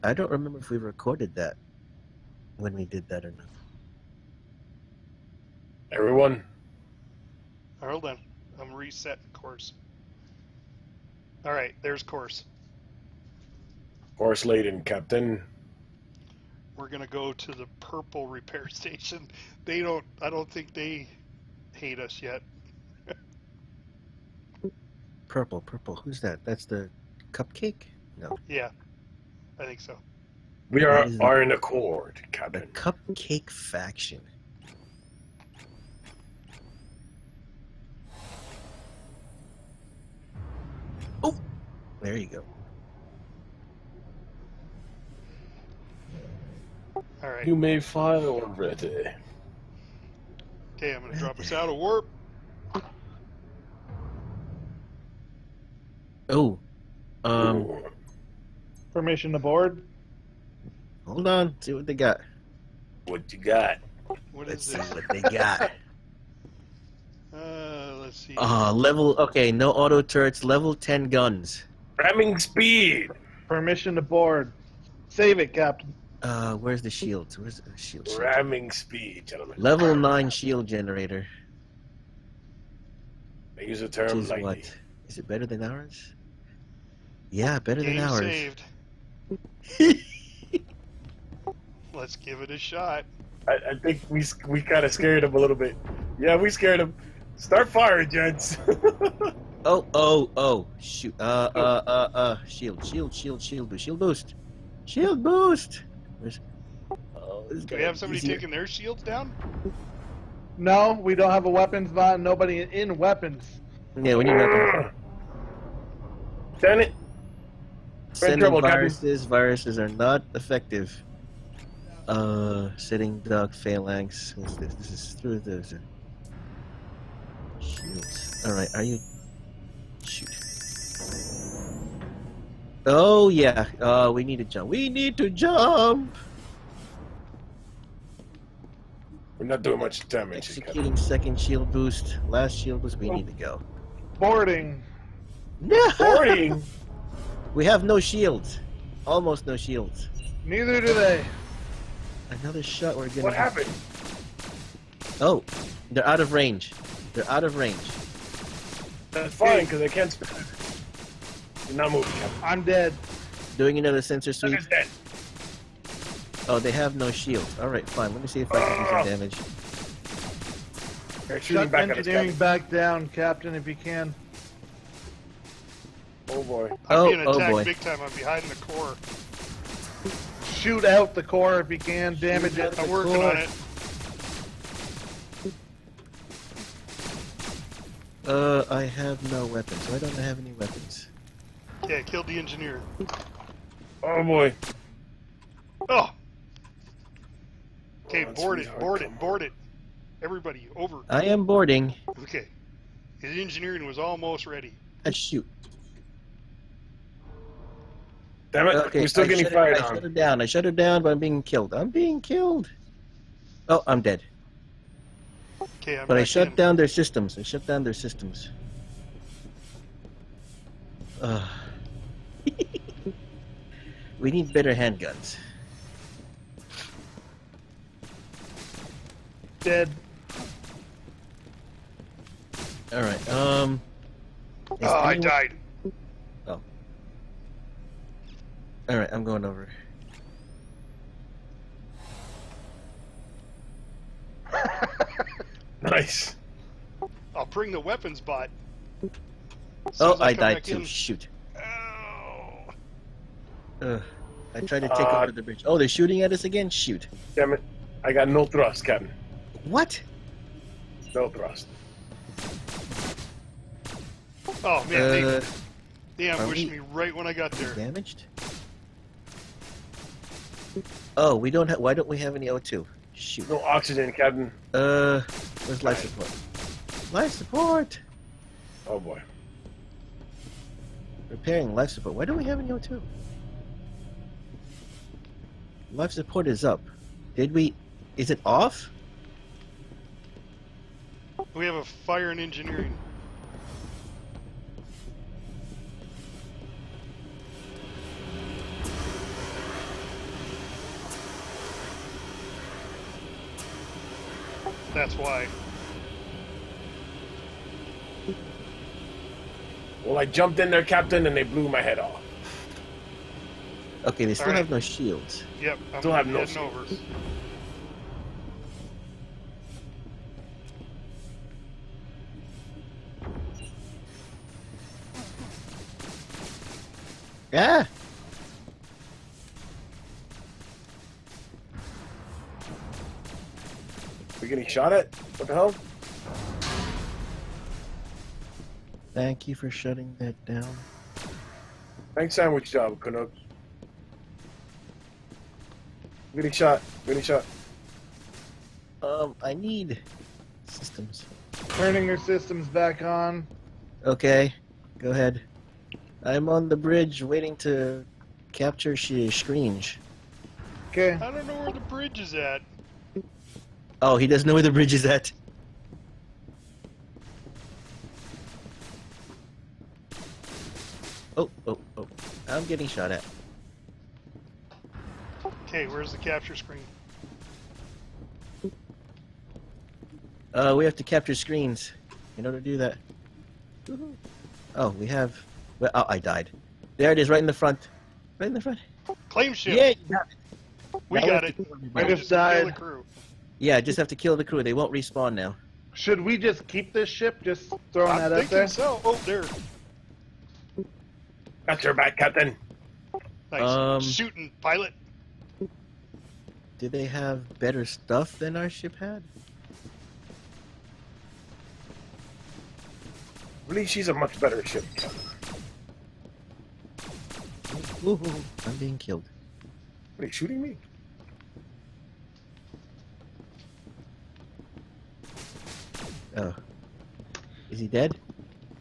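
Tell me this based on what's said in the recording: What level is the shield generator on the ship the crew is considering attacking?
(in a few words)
9.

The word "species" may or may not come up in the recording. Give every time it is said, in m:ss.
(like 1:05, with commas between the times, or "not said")
not said.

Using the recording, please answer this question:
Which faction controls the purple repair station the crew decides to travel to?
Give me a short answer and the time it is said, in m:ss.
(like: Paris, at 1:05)
The cupcake faction, at 0:32.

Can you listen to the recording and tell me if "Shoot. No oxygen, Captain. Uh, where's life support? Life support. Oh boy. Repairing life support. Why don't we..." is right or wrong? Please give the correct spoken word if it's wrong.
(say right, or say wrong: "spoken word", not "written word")
right.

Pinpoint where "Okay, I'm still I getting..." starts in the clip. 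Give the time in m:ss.
3:28.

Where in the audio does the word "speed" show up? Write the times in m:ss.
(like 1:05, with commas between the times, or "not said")
1:12, 1:18.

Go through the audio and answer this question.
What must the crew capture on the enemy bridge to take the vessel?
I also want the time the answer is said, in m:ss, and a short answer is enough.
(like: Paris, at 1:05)
Capture screens, at 6:21.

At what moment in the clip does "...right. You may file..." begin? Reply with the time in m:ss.
0:47.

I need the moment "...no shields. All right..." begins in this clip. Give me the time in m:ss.
2:46.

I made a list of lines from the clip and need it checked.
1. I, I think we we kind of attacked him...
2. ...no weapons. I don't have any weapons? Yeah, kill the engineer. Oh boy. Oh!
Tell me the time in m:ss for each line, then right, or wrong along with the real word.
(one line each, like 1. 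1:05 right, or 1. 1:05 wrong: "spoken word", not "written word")
1. 1:33 wrong: "scared", not "attacked"
2. 3:09 right.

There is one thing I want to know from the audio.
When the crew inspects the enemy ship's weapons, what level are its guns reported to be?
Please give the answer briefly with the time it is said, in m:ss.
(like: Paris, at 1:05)
10, at 1:10.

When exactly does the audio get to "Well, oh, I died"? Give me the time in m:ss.
6:25.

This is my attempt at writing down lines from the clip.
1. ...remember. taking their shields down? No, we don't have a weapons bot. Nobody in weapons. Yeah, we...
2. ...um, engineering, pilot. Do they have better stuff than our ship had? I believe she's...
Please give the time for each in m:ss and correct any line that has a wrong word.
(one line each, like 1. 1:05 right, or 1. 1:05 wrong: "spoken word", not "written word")
1. 1:48 wrong: "easier", not "remember"
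2. 6:43 wrong: "shooting", not "engineering".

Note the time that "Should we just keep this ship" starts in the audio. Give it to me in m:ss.
6:35.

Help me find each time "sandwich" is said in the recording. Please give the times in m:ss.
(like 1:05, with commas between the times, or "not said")
5:42.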